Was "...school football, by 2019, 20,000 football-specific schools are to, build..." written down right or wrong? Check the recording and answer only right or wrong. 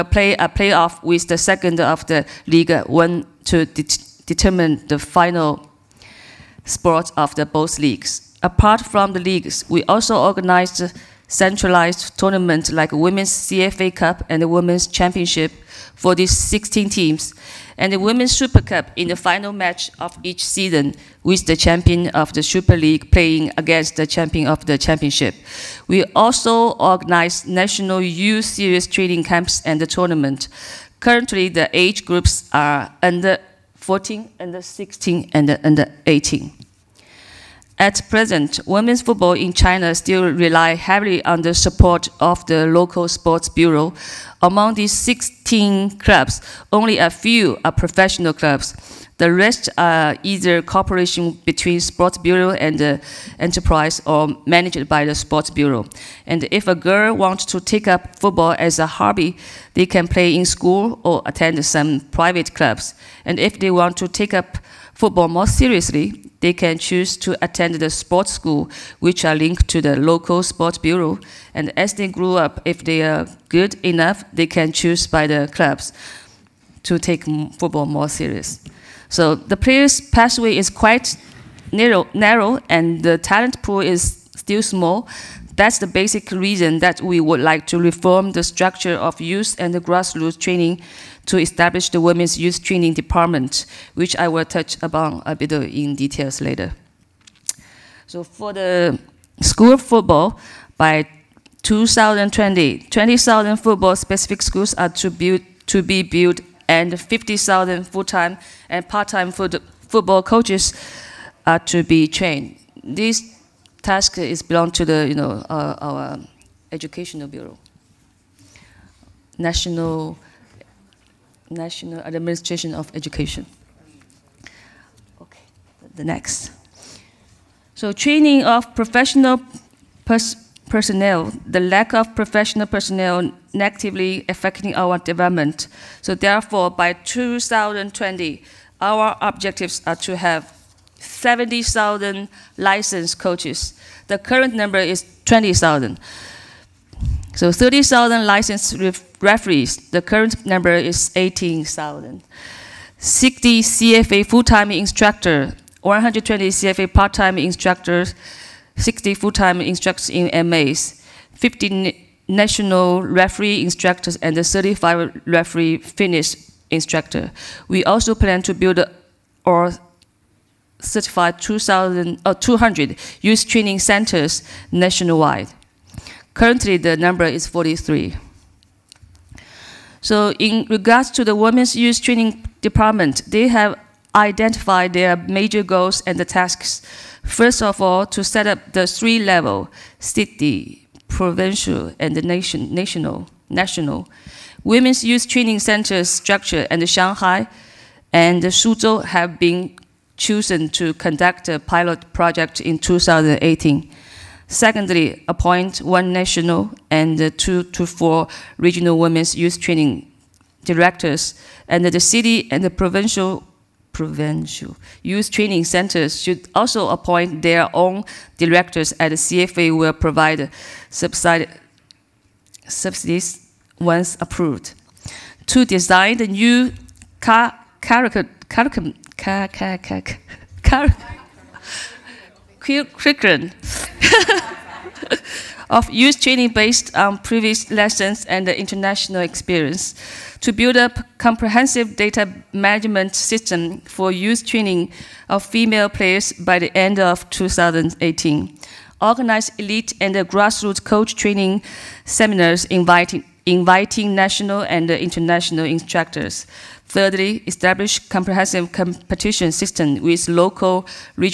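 wrong.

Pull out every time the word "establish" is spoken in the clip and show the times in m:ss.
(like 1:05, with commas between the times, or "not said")
1:31, 4:17.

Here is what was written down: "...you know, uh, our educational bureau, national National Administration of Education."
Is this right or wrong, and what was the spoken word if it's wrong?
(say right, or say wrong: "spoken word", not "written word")
right.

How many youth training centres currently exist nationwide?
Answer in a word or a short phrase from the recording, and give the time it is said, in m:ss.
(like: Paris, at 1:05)
43, at 2:57.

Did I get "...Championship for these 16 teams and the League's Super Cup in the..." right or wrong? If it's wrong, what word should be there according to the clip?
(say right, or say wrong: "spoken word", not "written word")
wrong: "Women", not "League".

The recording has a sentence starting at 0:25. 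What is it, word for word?
We also organize national youth series training camps and the tournament.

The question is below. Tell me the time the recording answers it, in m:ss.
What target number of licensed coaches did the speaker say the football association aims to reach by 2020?
2:20.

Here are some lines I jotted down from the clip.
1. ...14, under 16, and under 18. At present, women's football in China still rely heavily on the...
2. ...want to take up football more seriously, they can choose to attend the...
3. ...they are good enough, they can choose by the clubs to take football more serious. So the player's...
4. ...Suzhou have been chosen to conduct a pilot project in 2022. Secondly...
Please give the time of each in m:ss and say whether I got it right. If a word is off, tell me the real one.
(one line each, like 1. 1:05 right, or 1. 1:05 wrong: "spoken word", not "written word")
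1. 0:33 right
2. 1:03 right
3. 1:12 right
4. 3:18 wrong: "2018", not "2022".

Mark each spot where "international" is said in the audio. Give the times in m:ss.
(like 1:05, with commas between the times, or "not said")
3:58, 4:14.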